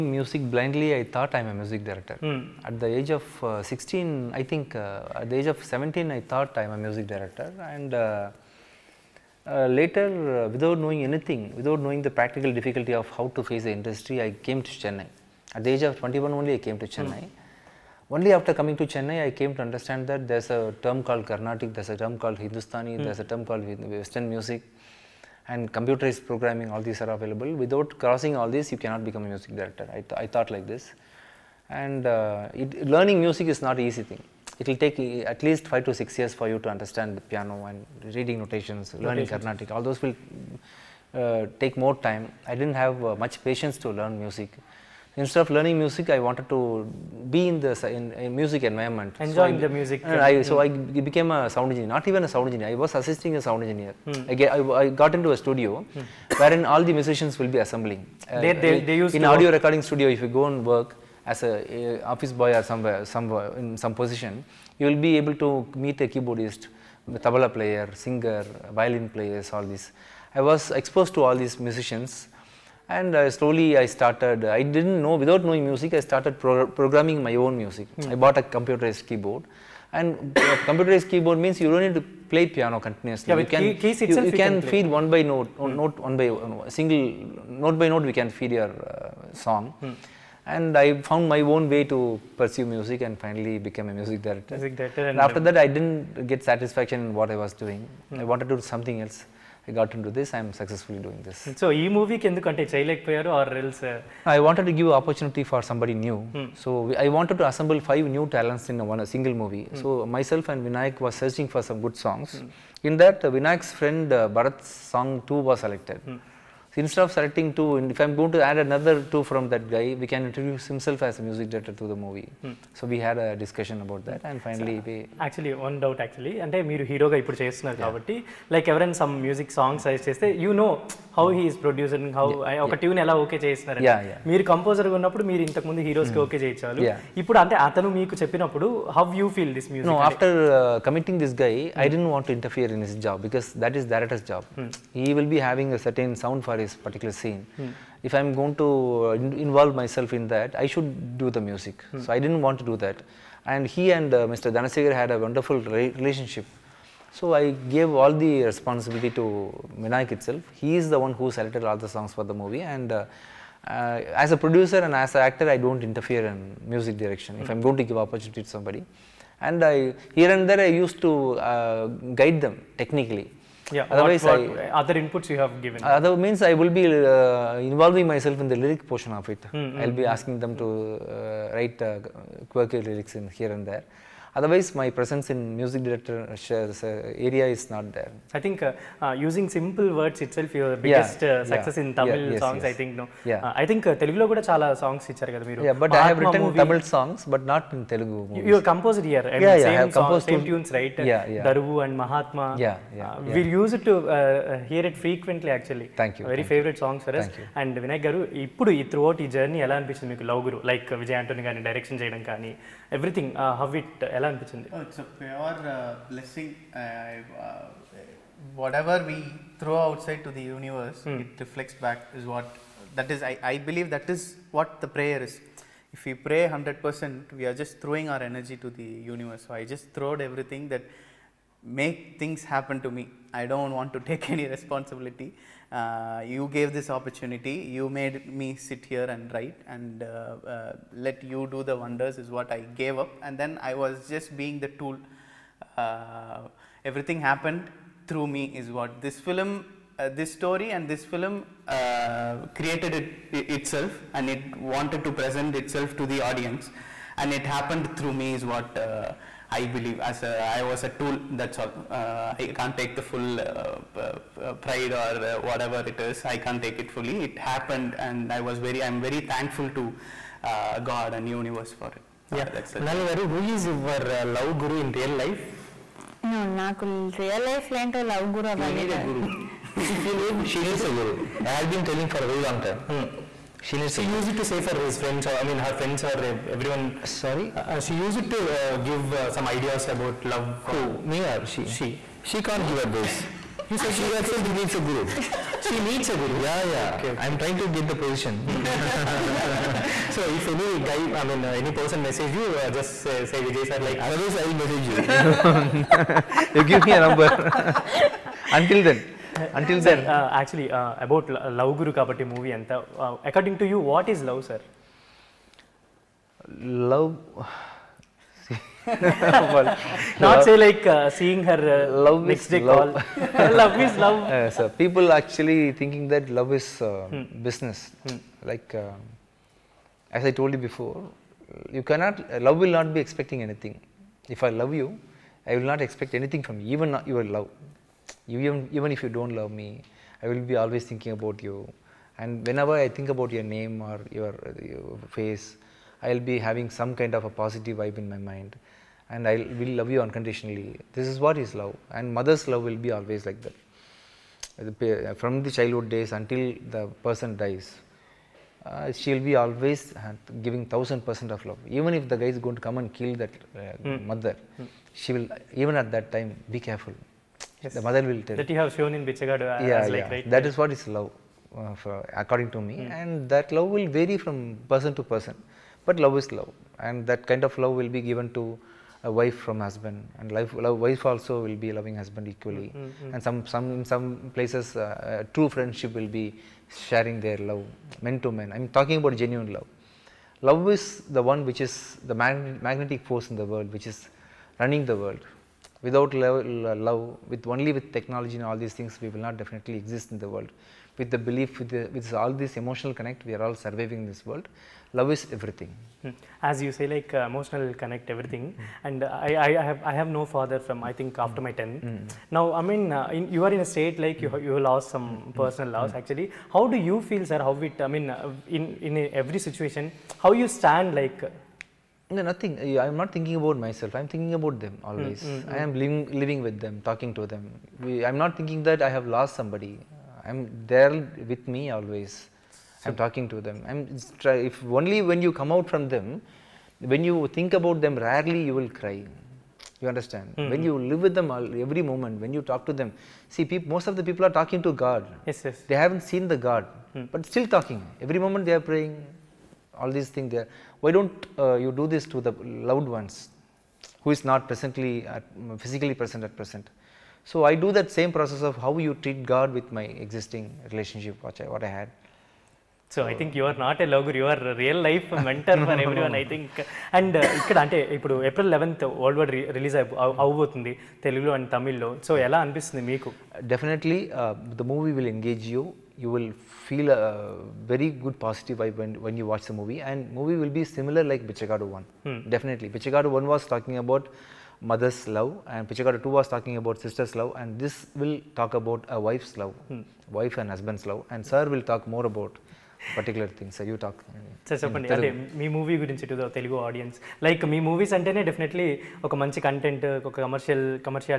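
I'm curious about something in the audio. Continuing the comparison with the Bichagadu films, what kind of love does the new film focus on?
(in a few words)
Wife's love.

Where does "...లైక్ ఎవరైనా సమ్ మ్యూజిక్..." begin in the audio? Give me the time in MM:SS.
02:08.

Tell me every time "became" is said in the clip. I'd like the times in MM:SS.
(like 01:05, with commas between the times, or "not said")
00:51, 01:33.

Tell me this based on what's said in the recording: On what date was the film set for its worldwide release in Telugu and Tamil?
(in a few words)
April 11.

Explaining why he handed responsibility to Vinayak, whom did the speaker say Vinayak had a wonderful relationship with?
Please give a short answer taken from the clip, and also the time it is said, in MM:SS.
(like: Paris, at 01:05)
Mr. Danasegar, at 02:34.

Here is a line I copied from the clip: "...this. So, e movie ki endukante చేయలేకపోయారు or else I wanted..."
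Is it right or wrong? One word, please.
right.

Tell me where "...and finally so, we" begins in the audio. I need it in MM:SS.
02:04.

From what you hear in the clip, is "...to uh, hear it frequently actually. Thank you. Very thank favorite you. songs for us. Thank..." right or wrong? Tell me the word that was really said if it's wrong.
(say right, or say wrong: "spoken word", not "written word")
right.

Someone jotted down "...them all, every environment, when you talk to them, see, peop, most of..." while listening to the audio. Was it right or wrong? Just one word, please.
wrong.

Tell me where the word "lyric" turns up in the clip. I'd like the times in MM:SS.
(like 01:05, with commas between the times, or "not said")
02:58, 03:02.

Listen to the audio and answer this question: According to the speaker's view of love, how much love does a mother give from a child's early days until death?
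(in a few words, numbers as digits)
1000 percent.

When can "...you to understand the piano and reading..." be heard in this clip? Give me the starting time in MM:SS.
00:36.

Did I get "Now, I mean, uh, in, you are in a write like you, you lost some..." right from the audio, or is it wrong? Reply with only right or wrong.
wrong.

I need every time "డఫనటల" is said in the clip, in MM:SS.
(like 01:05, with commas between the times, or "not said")
07:53, 08:18.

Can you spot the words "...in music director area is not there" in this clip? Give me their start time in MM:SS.
03:05.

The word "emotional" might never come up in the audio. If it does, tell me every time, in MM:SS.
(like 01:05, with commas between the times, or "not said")
06:42, 06:47.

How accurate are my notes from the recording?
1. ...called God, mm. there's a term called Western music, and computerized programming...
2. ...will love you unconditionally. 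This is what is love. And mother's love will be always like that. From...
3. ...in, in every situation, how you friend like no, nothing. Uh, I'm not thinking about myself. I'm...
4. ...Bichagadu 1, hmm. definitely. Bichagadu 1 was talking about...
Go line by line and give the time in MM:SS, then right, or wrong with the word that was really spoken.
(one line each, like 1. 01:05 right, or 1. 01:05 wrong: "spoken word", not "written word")
1. 00:22 wrong: "Hindustani", not "God"
2. 05:49 right
3. 06:58 wrong: "stand", not "friend"
4. 08:01 right.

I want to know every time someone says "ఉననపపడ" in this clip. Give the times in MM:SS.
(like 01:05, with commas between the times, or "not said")
02:14.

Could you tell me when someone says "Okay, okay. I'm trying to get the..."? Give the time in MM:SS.
04:56.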